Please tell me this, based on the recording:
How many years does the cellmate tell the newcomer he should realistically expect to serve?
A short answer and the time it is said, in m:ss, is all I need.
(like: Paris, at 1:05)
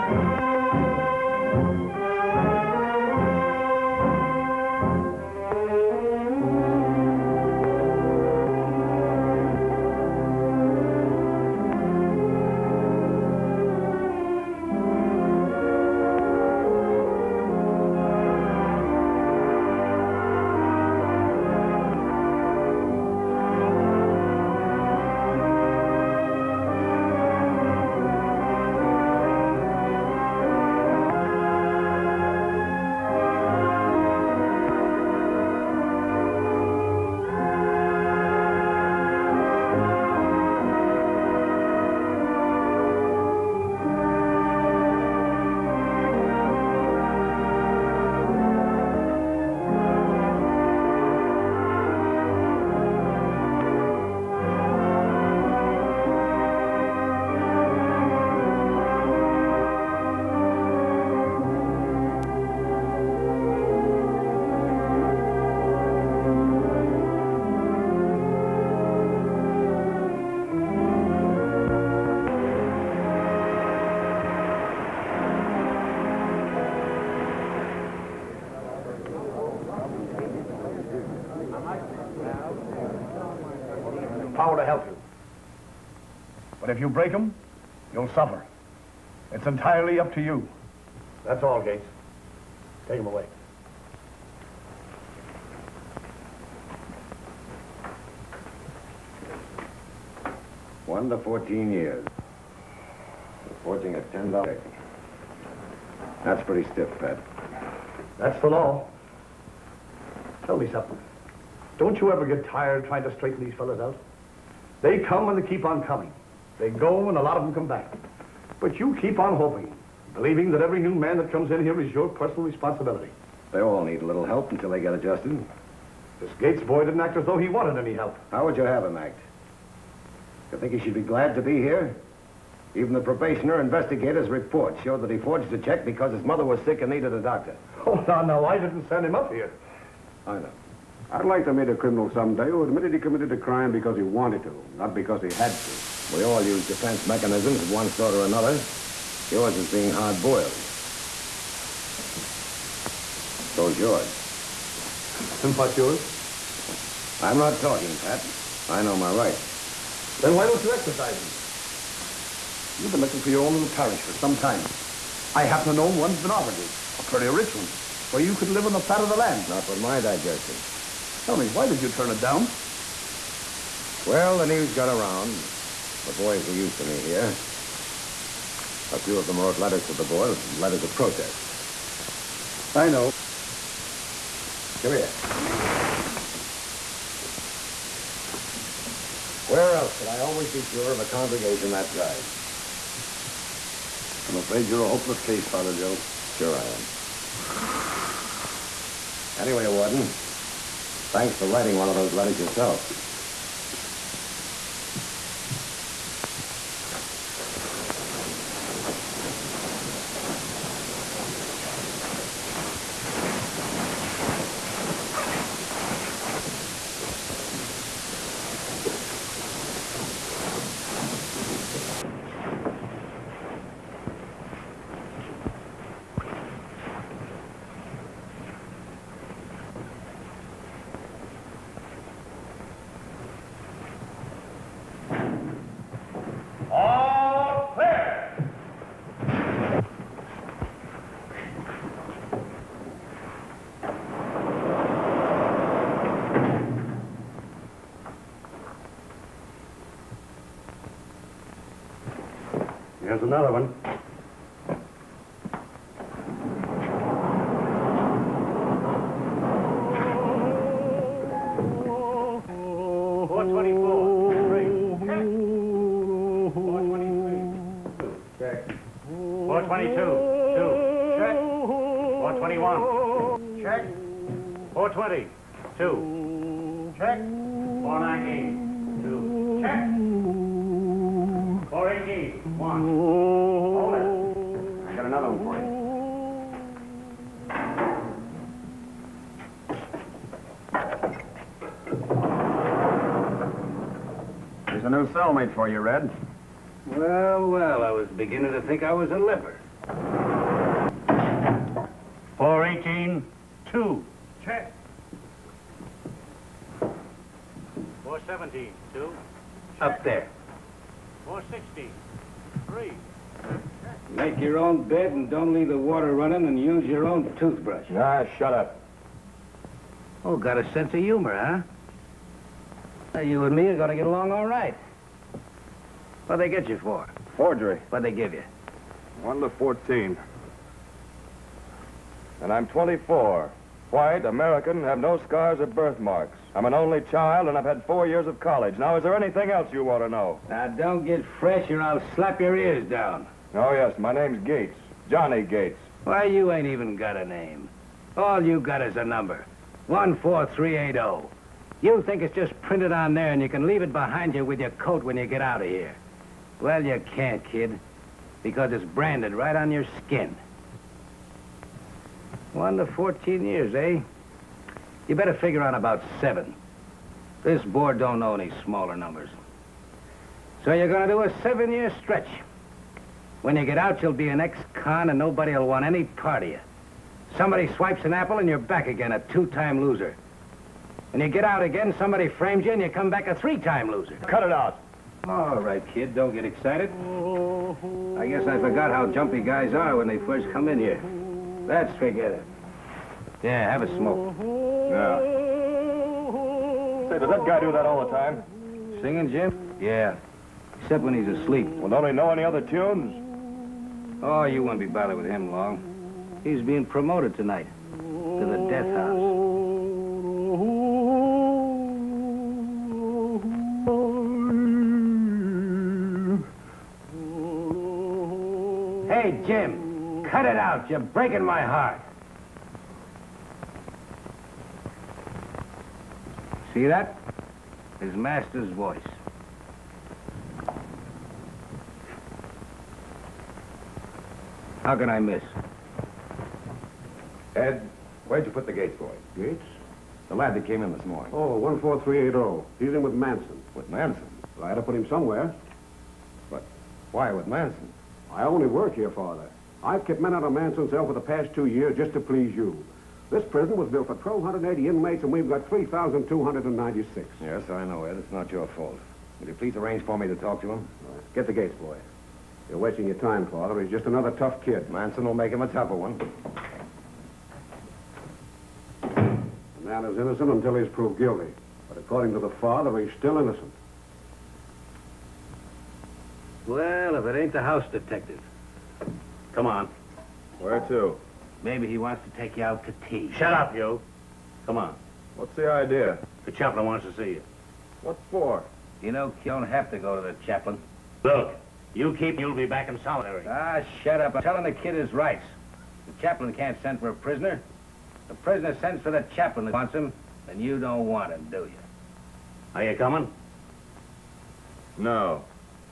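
7, at 6:06.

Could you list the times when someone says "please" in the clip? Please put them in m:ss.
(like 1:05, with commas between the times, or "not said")
7:32, 7:39.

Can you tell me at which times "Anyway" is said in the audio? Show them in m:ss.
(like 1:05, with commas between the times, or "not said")
3:19.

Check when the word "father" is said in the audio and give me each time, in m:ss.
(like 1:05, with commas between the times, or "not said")
3:15, 7:29, 7:43, 7:52.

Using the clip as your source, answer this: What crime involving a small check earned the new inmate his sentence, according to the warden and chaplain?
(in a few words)
Forging a $10.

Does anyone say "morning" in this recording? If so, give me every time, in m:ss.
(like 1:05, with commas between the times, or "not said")
7:21.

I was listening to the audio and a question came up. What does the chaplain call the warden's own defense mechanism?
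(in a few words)
Being hard-boiled.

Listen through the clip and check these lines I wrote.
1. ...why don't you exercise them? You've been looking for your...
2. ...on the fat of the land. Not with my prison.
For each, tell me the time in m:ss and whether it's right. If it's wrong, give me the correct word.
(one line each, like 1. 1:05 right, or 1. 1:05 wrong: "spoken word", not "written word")
1. 2:40 right
2. 2:48 wrong: "digestion", not "prison".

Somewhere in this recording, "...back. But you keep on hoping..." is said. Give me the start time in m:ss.
1:57.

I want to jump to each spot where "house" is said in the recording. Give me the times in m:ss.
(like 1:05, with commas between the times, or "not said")
6:48, 7:57.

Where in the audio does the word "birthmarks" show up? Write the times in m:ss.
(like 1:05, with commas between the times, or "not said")
5:35.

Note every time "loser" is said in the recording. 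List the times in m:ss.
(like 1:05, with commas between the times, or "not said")
6:19, 6:23.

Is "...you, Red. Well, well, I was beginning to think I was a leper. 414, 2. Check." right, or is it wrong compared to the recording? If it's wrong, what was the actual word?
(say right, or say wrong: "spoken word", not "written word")
wrong: "418", not "414".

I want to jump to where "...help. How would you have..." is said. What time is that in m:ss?
2:07.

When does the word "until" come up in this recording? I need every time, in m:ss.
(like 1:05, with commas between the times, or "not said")
2:04, 7:50.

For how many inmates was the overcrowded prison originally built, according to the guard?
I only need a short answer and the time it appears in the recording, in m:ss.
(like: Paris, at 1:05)
1,280, at 7:34.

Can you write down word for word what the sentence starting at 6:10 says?
So you're gonna do a seven-year stretch.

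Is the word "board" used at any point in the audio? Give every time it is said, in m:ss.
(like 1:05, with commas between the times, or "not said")
3:00, 6:07.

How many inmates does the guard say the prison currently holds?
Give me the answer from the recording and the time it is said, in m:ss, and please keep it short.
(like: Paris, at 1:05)
3,296, at 7:35.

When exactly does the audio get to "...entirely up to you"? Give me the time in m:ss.
1:29.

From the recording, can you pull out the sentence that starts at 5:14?
Make your own bed and don't leave the water running and use your own toothbrush.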